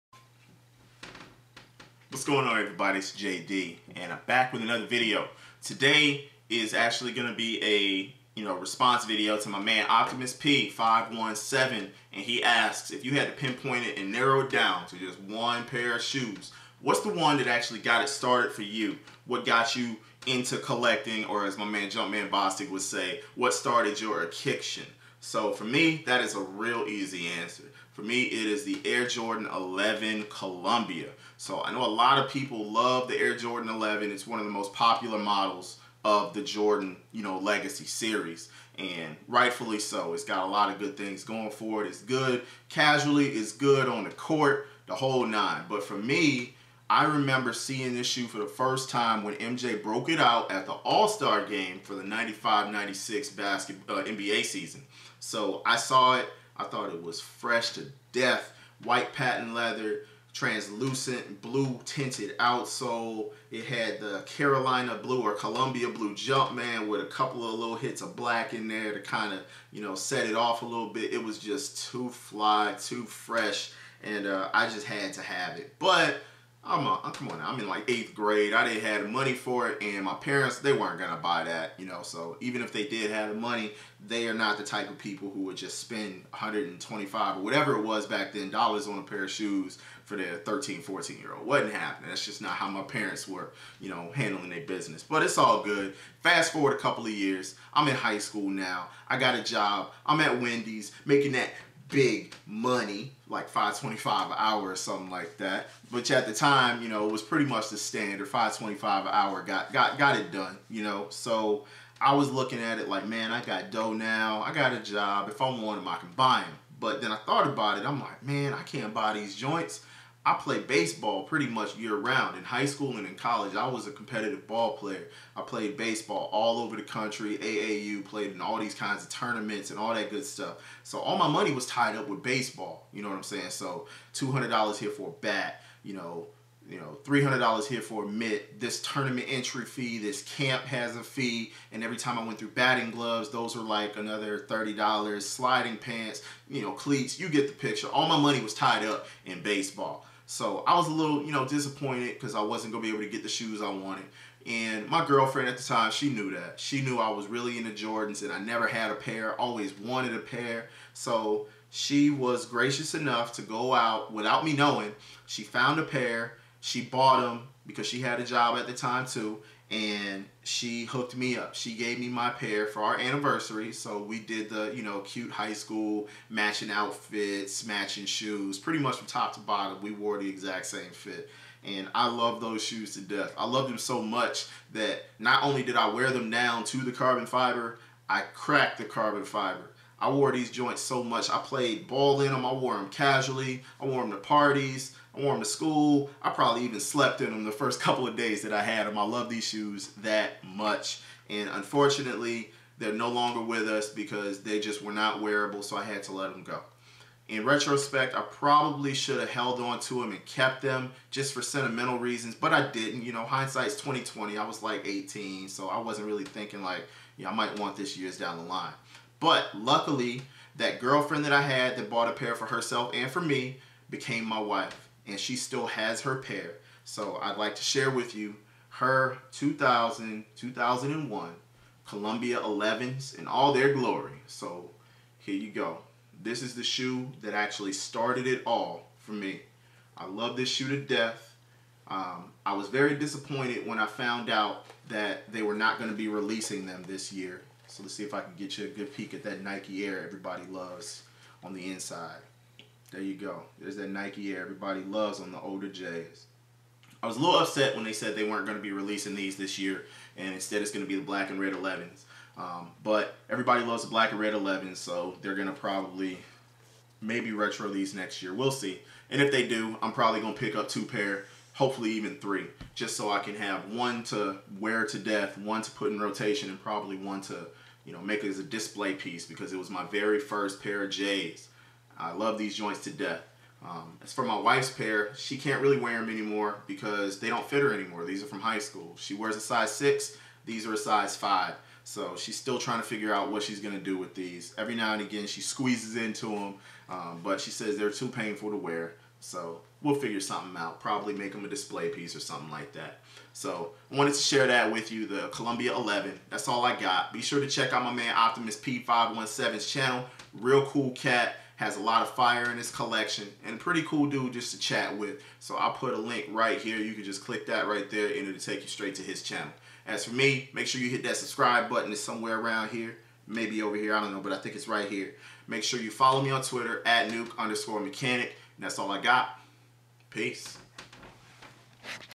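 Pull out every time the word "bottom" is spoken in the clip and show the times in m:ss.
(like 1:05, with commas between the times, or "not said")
2:59.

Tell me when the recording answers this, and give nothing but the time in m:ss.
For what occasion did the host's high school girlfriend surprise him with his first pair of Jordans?
2:52.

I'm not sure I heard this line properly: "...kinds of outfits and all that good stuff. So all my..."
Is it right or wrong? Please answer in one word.
wrong.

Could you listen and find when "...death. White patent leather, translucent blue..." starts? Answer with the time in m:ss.
0:58.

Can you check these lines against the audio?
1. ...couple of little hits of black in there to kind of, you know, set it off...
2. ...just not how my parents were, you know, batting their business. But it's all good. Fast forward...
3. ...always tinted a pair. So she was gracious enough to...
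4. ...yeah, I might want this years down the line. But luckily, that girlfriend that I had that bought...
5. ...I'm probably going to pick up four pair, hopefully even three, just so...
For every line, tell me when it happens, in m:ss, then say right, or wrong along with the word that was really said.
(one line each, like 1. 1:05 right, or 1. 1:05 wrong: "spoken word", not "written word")
1. 1:07 right
2. 1:32 wrong: "handling", not "batting"
3. 2:39 wrong: "wanted", not "tinted"
4. 3:37 right
5. 4:29 wrong: "two", not "four".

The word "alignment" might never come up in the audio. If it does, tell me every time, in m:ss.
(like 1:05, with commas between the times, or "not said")
not said.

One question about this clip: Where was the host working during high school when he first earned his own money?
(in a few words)
Wendy's.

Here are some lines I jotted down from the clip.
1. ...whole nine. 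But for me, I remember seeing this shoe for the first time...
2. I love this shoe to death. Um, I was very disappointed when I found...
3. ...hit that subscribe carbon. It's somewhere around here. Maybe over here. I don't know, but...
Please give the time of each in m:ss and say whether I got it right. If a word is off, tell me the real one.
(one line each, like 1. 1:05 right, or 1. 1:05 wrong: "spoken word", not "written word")
1. 0:44 right
2. 3:59 right
3. 5:20 wrong: "button", not "carbon".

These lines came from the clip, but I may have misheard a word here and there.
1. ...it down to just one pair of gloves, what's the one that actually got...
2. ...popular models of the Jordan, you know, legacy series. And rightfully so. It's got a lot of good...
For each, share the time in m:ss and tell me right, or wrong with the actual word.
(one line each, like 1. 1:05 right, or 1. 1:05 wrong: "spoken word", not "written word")
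1. 0:14 wrong: "shoes", not "gloves"
2. 0:34 right.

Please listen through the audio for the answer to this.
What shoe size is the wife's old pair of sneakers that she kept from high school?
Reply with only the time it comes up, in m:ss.
4:50.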